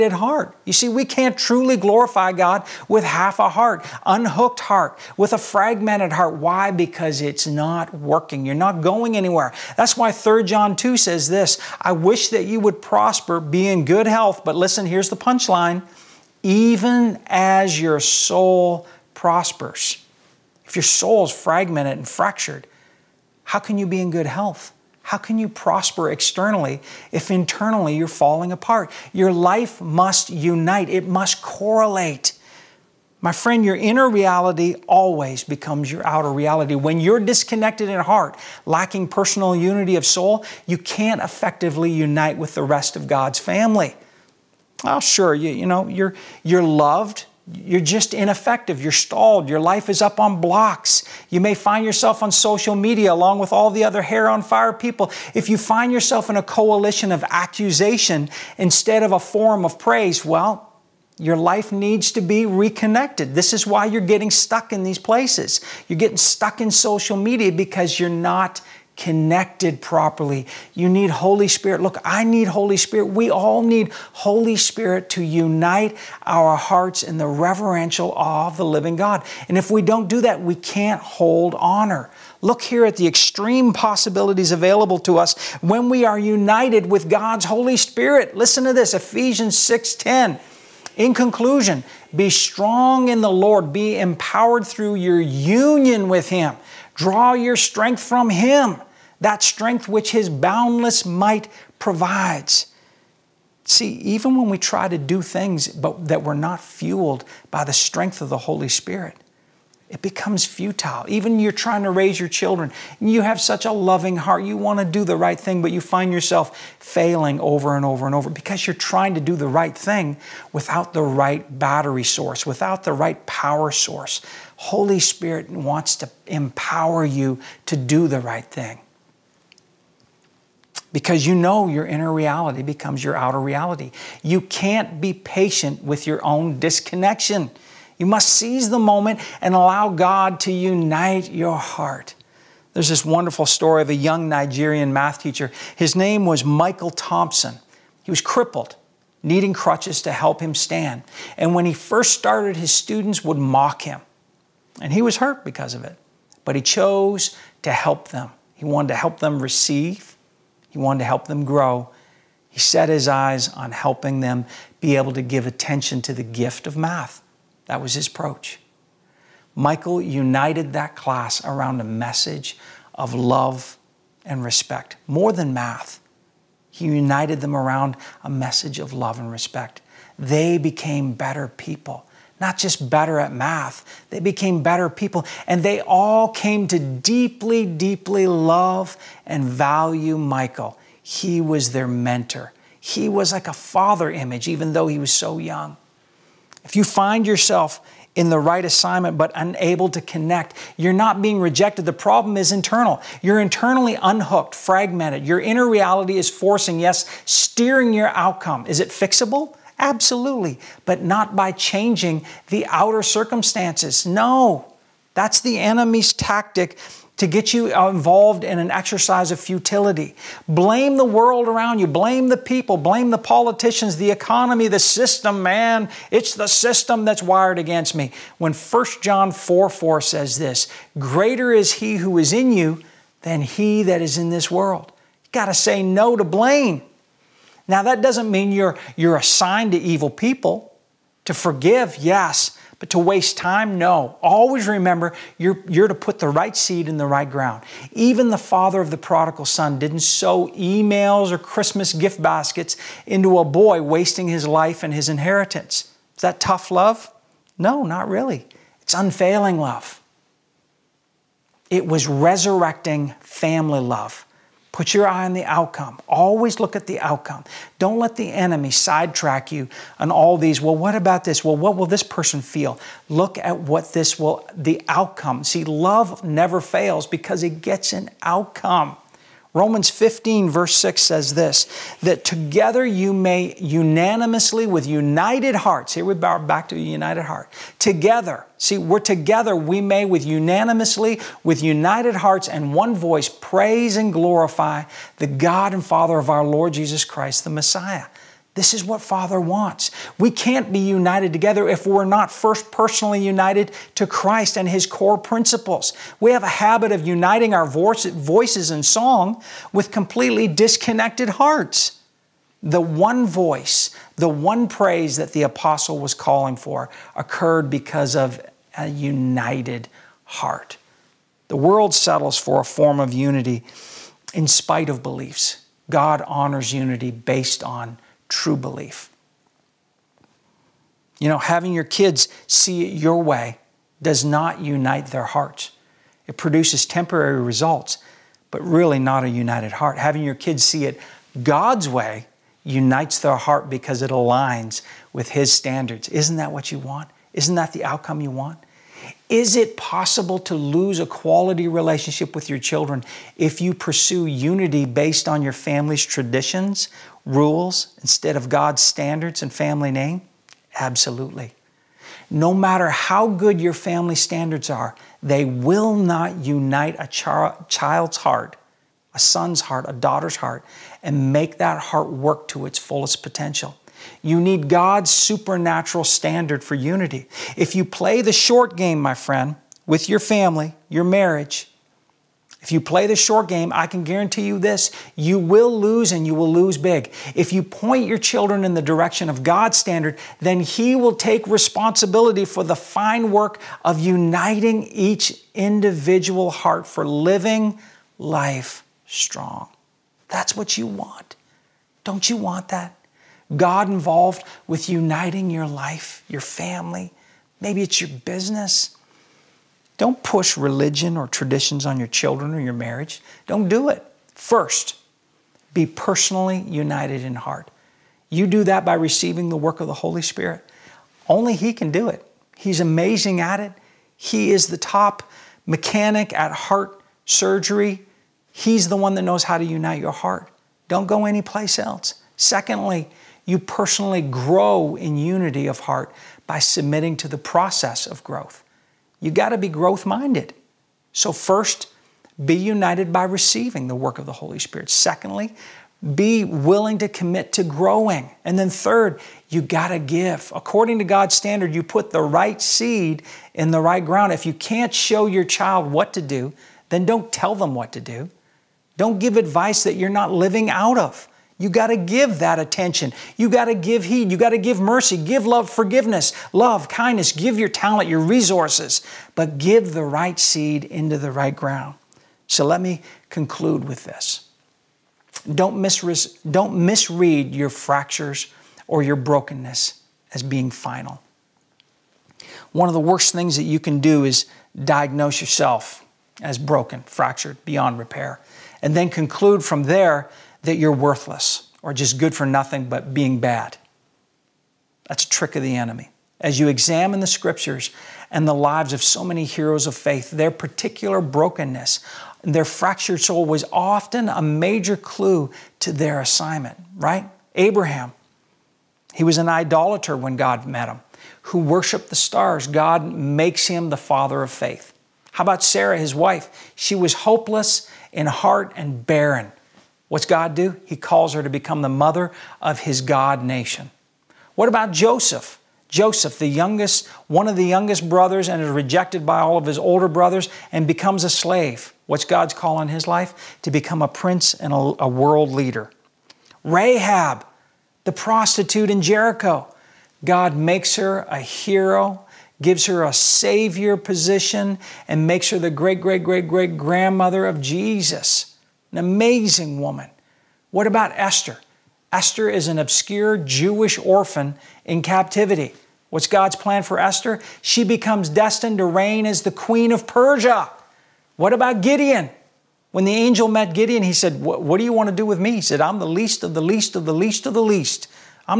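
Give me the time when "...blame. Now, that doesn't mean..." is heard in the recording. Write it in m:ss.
3:56.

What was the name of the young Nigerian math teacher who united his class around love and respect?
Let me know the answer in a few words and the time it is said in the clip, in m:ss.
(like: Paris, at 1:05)
Michael Thompson, at 2:26.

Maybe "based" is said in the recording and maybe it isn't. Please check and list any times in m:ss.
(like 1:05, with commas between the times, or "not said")
5:27, 5:54.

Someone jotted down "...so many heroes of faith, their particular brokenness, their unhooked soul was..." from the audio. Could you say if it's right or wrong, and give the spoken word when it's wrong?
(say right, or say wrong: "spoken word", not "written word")
wrong: "fractured", not "unhooked".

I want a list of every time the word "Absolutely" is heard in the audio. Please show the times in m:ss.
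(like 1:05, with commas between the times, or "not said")
3:29, 6:00.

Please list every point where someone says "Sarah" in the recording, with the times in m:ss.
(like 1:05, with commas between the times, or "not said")
8:35.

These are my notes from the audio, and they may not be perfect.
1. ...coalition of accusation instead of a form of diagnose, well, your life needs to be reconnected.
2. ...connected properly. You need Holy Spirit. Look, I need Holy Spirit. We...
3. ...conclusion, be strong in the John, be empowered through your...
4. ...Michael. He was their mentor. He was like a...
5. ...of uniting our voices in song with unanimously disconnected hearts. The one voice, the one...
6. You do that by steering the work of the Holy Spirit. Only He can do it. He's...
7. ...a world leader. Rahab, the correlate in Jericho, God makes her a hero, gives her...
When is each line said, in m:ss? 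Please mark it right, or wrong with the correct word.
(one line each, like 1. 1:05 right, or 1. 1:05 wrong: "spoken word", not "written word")
1. 0:56 wrong: "praise", not "diagnose"
2. 1:08 right
3. 1:31 wrong: "Lord", not "John"
4. 3:10 right
5. 5:06 wrong: "completely", not "unanimously"
6. 6:58 wrong: "receiving", not "steering"
7. 8:54 wrong: "prostitute", not "correlate".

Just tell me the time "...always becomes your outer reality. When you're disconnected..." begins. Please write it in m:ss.
0:34.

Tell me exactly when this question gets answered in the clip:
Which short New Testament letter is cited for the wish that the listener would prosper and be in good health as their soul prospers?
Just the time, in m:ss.
0:10.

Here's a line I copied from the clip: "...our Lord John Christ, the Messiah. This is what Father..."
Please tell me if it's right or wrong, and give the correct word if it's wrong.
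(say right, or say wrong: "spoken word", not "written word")
wrong: "Jesus", not "John".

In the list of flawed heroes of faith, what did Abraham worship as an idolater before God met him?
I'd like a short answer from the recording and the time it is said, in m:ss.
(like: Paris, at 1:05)
The stars, at 8:32.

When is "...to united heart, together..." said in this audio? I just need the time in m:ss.
4:46.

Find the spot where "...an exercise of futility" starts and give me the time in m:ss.
3:38.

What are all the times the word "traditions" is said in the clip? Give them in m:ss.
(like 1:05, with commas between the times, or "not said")
5:56, 6:51.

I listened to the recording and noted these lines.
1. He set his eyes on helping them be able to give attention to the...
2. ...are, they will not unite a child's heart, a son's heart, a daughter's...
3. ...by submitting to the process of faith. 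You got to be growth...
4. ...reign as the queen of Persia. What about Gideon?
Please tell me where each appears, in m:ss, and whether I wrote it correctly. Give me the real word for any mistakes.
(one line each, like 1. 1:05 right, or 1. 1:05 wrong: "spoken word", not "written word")
1. 2:42 right
2. 6:04 right
3. 7:16 wrong: "growth", not "faith"
4. 9:18 right.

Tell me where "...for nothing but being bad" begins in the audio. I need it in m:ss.
8:12.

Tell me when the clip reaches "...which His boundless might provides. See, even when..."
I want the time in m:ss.
1:39.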